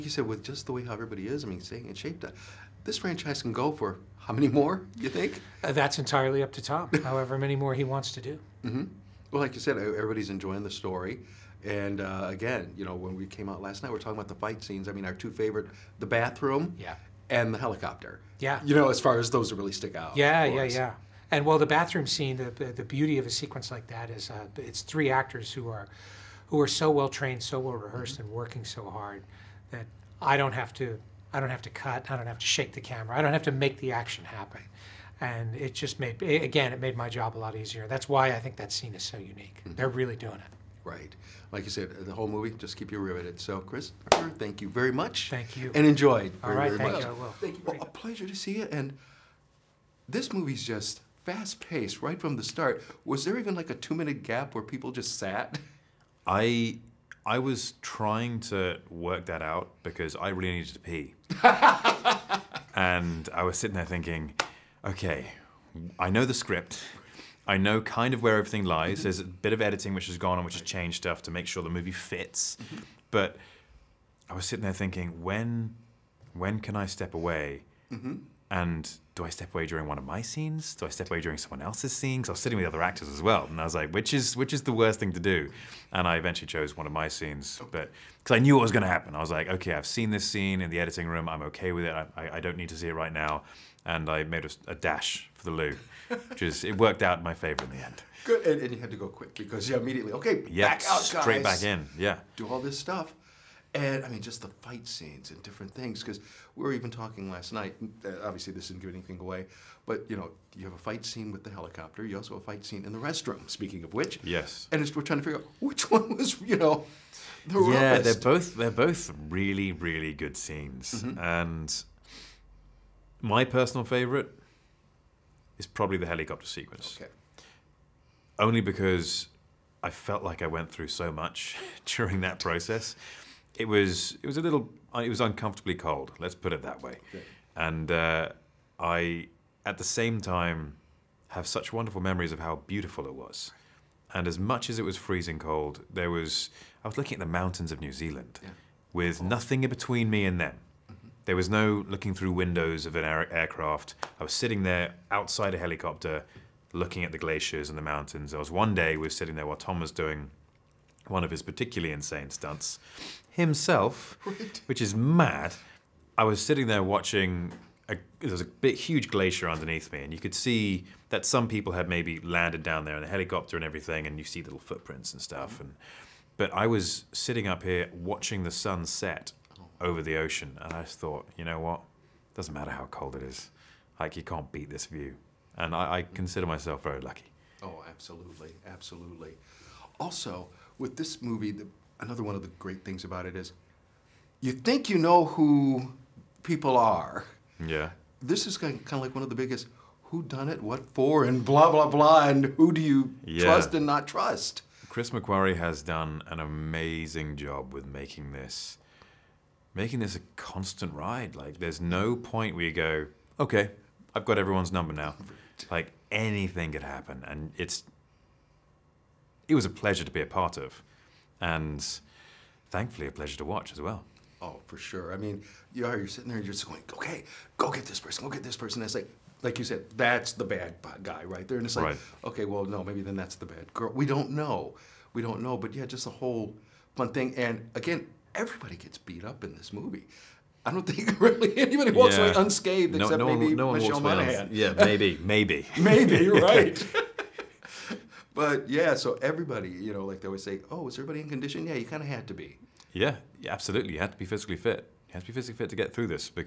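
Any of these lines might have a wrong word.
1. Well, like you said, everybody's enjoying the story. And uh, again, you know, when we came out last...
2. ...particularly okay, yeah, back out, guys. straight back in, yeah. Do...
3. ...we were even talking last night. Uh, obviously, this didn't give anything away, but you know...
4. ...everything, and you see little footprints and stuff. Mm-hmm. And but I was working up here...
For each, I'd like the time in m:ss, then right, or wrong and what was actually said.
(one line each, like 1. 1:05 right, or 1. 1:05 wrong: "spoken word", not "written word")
1. 0:09 right
2. 1:39 wrong: "immediately", not "particularly"
3. 1:46 right
4. 2:53 wrong: "sitting", not "working".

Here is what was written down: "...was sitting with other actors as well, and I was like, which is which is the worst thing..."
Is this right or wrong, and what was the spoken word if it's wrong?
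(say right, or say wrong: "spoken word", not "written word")
right.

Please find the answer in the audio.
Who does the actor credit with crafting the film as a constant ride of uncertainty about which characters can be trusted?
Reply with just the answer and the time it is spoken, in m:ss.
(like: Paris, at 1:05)
Chris McQuarrie, at 3:24.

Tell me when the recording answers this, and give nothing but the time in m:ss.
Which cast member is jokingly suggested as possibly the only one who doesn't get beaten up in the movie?
4:03.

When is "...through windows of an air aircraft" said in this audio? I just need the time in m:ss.
2:32.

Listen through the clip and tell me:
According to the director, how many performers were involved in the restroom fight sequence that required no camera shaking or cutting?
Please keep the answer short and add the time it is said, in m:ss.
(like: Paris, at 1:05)
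3, at 0:24.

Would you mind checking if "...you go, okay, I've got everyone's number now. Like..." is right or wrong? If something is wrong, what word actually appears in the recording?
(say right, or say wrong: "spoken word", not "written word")
right.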